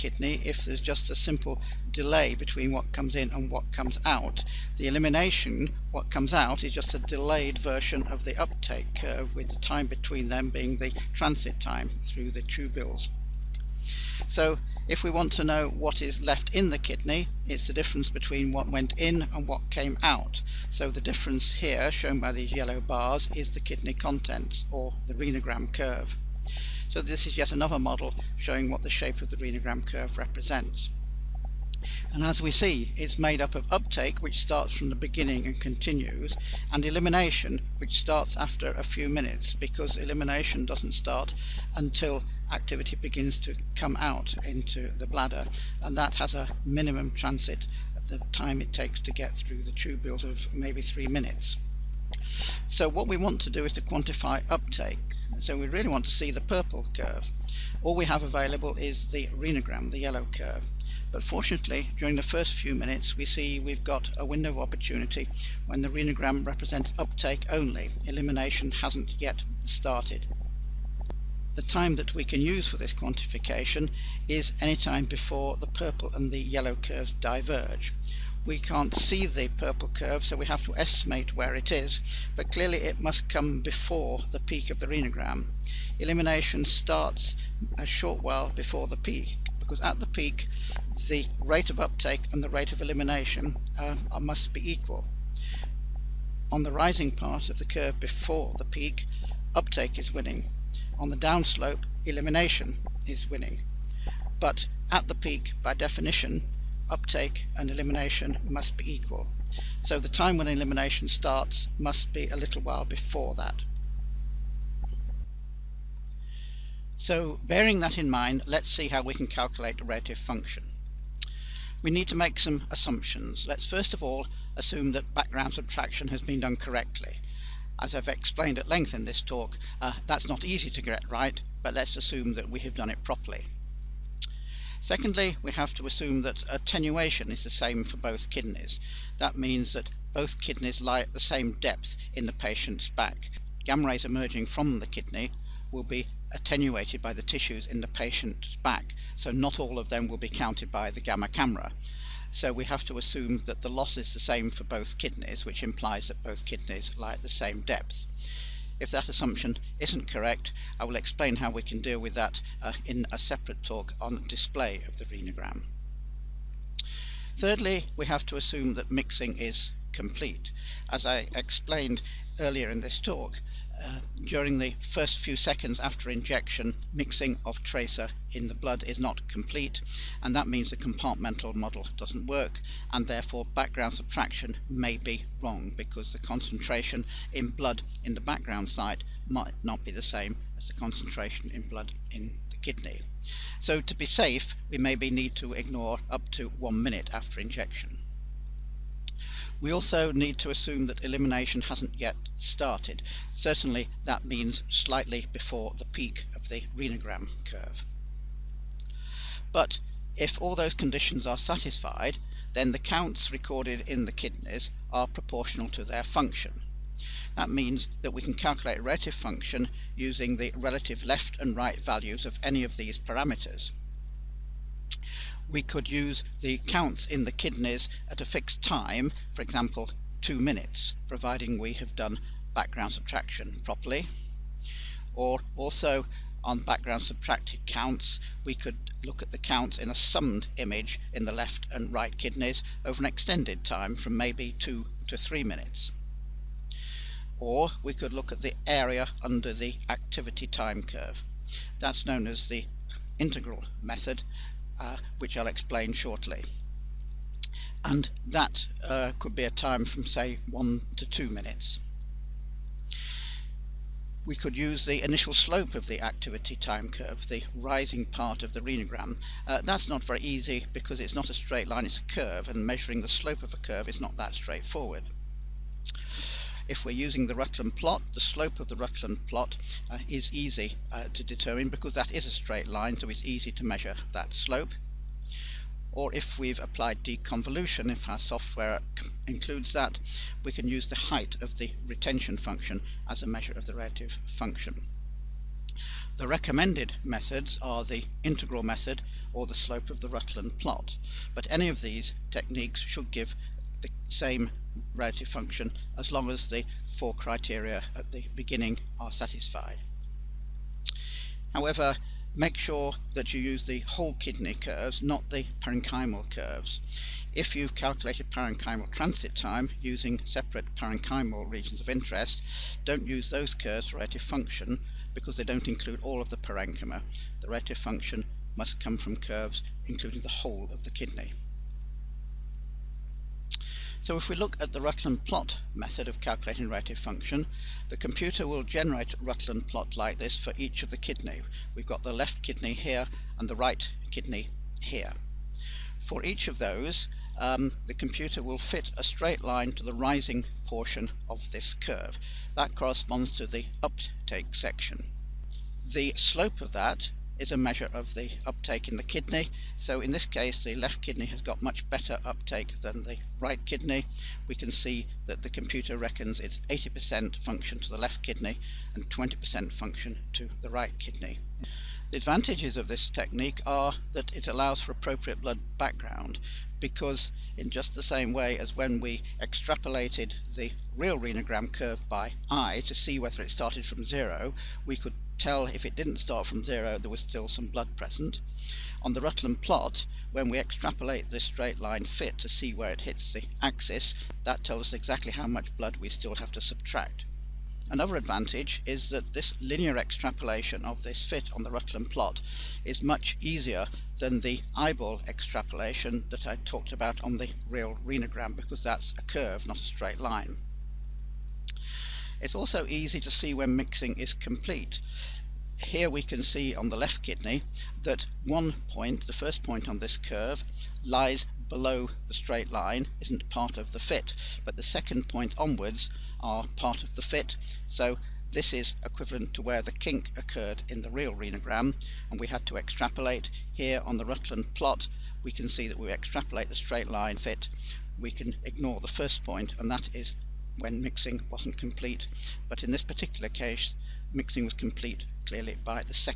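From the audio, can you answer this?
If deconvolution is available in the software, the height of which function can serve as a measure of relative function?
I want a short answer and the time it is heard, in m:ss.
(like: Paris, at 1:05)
retention function, at 4:51.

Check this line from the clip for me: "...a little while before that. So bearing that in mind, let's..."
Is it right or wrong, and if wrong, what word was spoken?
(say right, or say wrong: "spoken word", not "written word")
right.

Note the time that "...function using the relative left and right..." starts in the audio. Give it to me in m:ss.
3:39.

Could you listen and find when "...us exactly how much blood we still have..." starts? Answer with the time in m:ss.
6:34.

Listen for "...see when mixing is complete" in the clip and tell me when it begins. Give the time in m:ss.
6:53.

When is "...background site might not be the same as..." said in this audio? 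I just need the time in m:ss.
3:08.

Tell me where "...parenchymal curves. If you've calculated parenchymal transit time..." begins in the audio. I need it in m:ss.
5:15.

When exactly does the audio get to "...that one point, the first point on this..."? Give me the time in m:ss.
6:58.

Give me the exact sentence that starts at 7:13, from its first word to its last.
Here on the Rutland plot, we can see that we extrapolate the straight line fit.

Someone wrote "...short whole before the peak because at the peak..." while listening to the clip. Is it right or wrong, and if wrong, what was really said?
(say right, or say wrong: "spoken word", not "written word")
wrong: "while", not "whole".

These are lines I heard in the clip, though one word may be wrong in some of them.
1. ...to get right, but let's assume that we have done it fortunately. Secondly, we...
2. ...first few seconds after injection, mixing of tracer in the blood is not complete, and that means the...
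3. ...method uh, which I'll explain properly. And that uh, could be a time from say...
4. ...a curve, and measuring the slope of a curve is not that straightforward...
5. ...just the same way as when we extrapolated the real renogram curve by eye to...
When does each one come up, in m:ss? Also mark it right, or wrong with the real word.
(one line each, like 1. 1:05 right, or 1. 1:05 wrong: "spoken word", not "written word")
1. 2:10 wrong: "properly", not "fortunately"
2. 2:54 right
3. 4:13 wrong: "shortly", not "properly"
4. 4:31 right
5. 6:17 right.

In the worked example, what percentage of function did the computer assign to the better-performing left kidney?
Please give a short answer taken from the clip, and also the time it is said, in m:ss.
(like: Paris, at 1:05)
80%, at 6:06.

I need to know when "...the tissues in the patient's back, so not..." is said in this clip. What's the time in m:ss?
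2:27.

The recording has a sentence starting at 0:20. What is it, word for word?
So the difference here, shown by these yellow bars, is the kidney contents, or the renogram curve.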